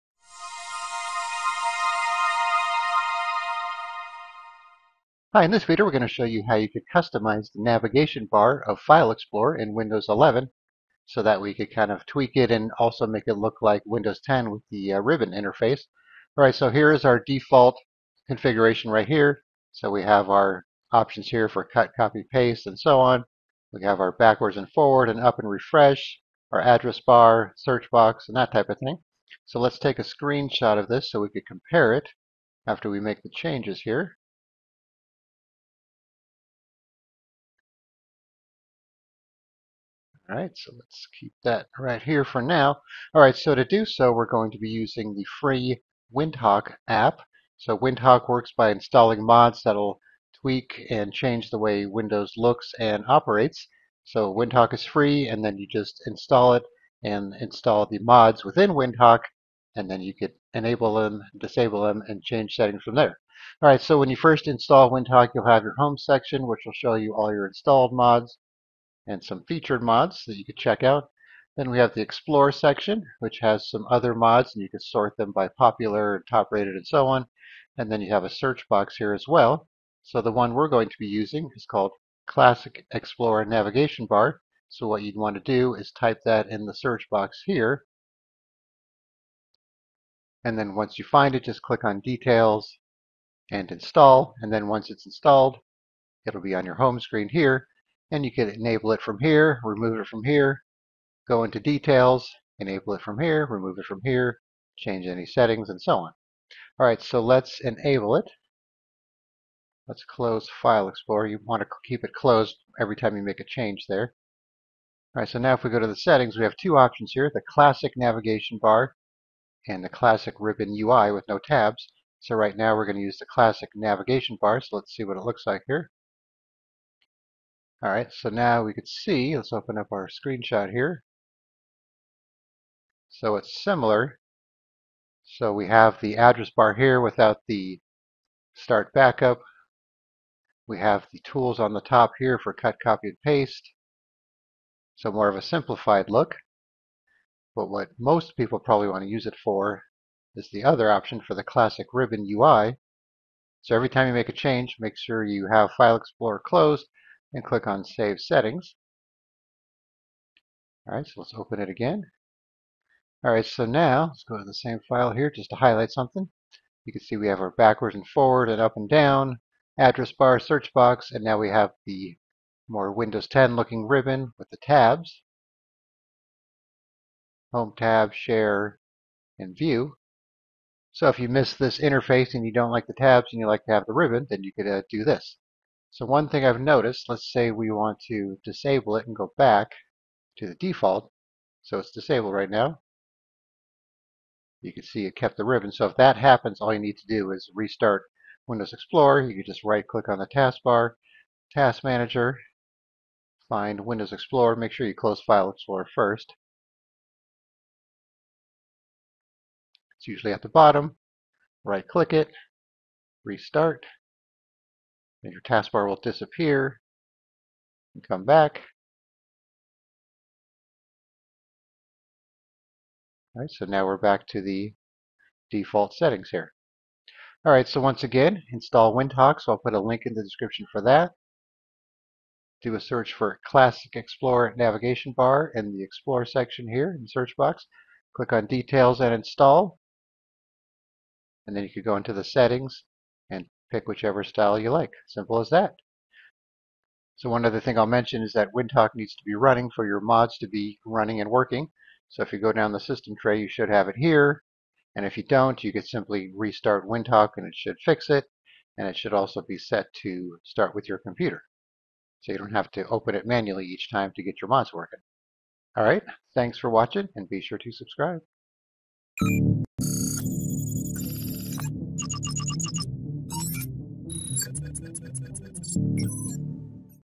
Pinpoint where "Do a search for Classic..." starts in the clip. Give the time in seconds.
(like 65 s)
232 s.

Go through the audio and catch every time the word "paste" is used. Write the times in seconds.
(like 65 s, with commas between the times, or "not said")
22 s, 143 s.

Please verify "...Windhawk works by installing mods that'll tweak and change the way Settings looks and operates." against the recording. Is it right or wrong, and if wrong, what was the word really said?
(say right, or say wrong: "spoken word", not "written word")
wrong: "Windows", not "Settings".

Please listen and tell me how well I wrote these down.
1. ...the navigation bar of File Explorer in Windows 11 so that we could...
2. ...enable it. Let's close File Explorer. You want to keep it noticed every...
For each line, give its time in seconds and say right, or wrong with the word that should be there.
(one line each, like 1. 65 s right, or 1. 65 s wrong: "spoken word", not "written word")
1. 7 s right
2. 107 s wrong: "closed", not "noticed".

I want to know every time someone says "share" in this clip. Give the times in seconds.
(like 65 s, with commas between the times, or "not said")
178 s.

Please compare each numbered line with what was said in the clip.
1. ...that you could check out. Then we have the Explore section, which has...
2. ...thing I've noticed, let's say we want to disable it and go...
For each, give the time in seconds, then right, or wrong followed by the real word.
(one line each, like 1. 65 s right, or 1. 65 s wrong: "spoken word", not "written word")
1. 70 s right
2. 186 s right.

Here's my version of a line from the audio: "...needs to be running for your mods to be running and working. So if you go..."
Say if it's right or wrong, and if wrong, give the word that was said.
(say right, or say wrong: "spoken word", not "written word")
right.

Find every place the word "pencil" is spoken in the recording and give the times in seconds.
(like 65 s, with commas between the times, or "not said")
not said.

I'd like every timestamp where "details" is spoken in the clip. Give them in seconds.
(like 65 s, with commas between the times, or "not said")
91 s, 101 s, 238 s.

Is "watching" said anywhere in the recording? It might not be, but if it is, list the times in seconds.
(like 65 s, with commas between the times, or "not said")
266 s.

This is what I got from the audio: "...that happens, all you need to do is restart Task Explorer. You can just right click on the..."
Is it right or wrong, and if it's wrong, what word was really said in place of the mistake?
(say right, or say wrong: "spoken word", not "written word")
wrong: "Windows", not "Task".